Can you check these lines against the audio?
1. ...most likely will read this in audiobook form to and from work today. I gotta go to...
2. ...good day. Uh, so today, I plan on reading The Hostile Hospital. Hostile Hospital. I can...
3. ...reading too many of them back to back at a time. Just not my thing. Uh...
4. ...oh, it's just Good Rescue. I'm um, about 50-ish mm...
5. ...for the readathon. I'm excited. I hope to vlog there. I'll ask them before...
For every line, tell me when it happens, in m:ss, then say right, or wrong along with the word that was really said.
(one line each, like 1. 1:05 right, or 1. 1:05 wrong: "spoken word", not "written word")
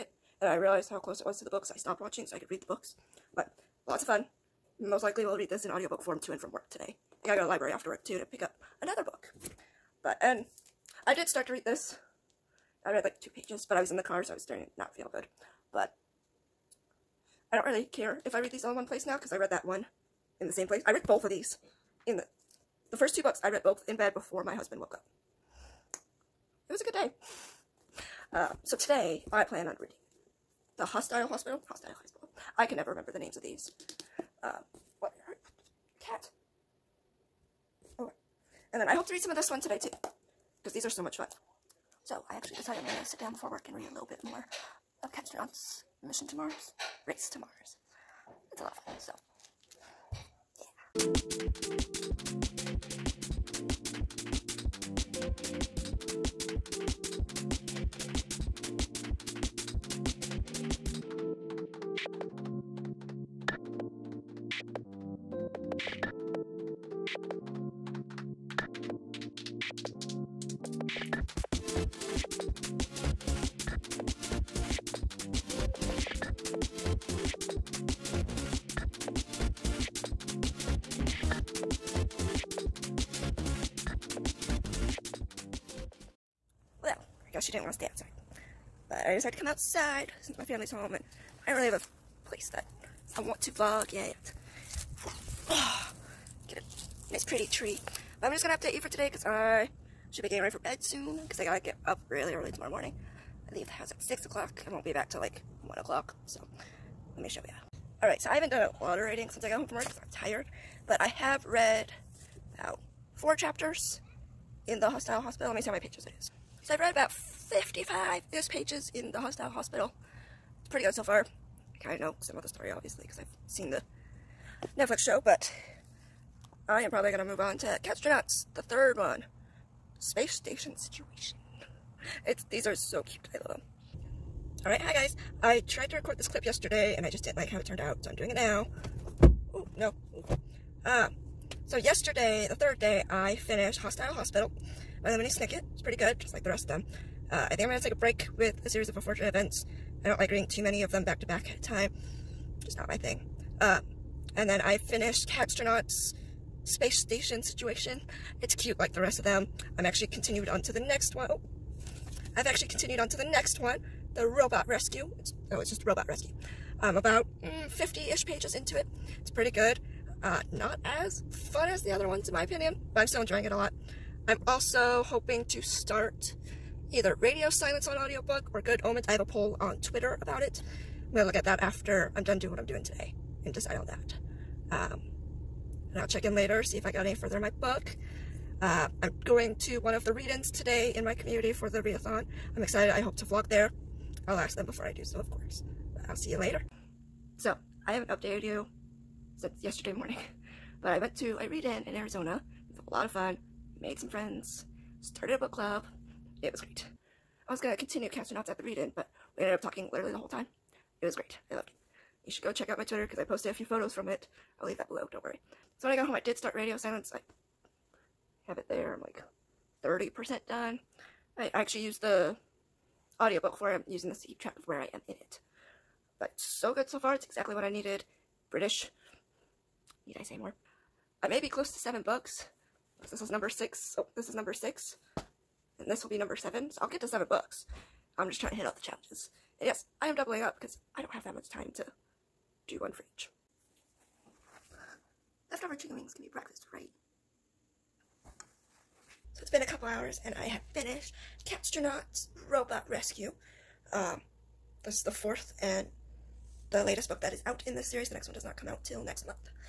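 1. 0:04 right
2. 0:26 right
3. 2:30 right
4. 2:45 wrong: "Robot", not "Good"
5. 3:11 right.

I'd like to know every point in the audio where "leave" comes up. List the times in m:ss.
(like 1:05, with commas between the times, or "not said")
1:43, 3:34.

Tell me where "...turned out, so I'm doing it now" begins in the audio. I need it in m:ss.
2:17.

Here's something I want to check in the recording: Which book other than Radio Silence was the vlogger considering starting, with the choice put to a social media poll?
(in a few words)
Good Omens.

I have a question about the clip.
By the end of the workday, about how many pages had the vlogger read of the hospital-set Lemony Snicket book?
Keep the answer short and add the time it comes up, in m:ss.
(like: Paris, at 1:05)
55, at 1:57.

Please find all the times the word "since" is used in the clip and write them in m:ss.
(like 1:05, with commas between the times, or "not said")
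1:30, 1:49, 3:19.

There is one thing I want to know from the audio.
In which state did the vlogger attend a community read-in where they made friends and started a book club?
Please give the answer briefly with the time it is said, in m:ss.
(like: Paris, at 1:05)
Arizona, at 3:21.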